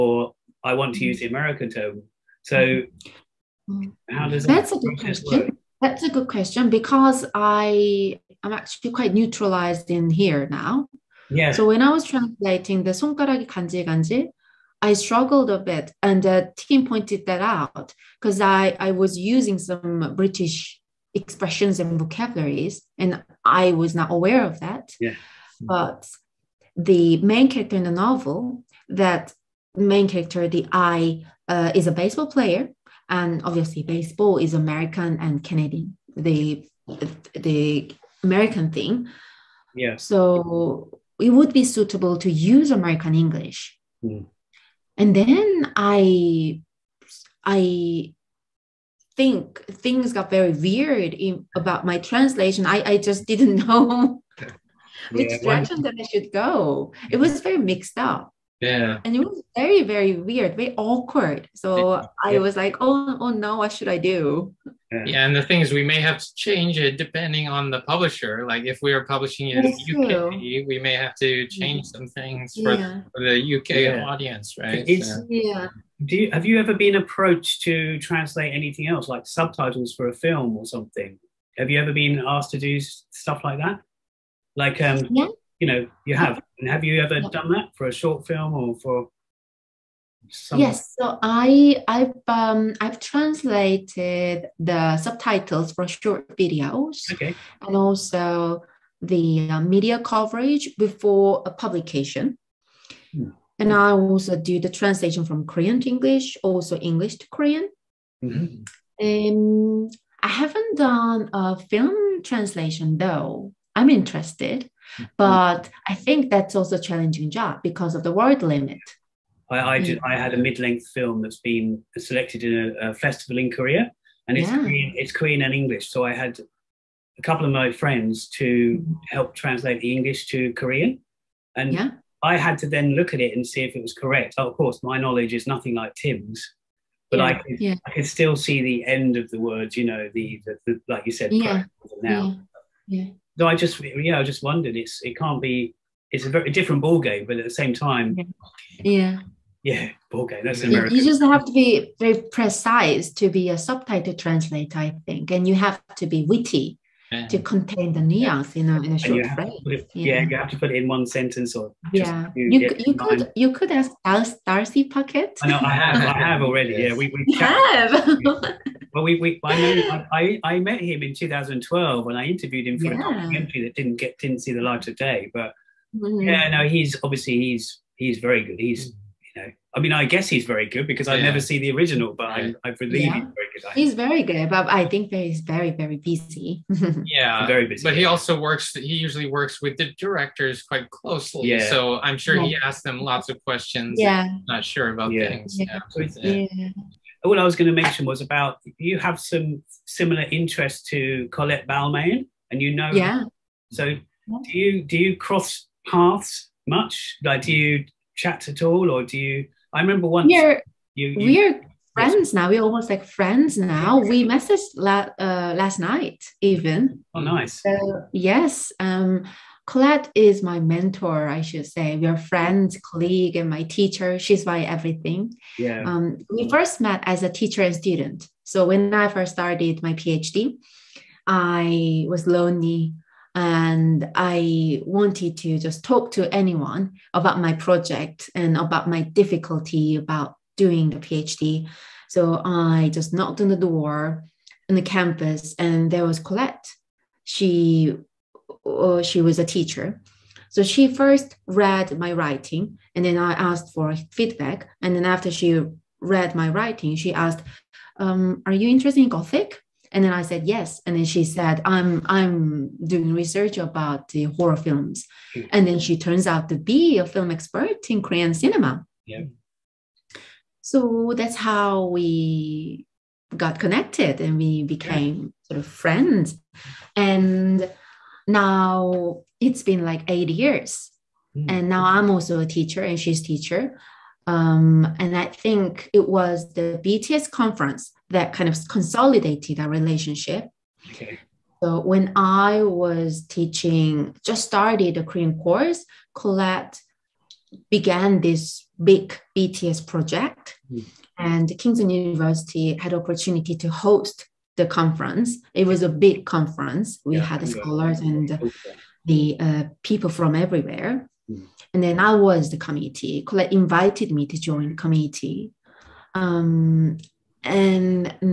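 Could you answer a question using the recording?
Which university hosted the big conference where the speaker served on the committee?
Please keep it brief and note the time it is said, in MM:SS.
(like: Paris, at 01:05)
Kingston University, at 05:01.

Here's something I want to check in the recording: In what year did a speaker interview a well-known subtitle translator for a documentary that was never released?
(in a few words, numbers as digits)
2012.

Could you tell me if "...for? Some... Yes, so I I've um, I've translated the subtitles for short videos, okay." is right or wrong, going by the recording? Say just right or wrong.
right.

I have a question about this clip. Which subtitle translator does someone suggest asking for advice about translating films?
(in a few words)
Darcy Paquet.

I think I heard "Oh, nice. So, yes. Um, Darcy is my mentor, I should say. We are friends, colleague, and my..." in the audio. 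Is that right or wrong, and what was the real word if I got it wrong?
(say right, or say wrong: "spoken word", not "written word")
wrong: "Colette", not "Darcy".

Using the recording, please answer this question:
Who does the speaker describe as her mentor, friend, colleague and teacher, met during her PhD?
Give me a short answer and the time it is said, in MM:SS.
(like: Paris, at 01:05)
Colette Balmain, at 03:21.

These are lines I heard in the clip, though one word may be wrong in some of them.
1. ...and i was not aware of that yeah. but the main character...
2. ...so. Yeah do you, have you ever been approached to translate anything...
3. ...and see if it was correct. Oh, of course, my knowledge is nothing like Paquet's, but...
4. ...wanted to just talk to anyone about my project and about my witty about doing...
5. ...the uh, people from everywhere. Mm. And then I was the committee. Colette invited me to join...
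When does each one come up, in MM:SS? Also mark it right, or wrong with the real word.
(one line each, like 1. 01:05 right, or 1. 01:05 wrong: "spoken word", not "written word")
1. 00:22 right
2. 01:15 right
3. 02:13 wrong: "Tim", not "Paquet"
4. 03:54 wrong: "difficulty", not "witty"
5. 05:09 right.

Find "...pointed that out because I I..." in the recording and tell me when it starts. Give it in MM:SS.
00:16.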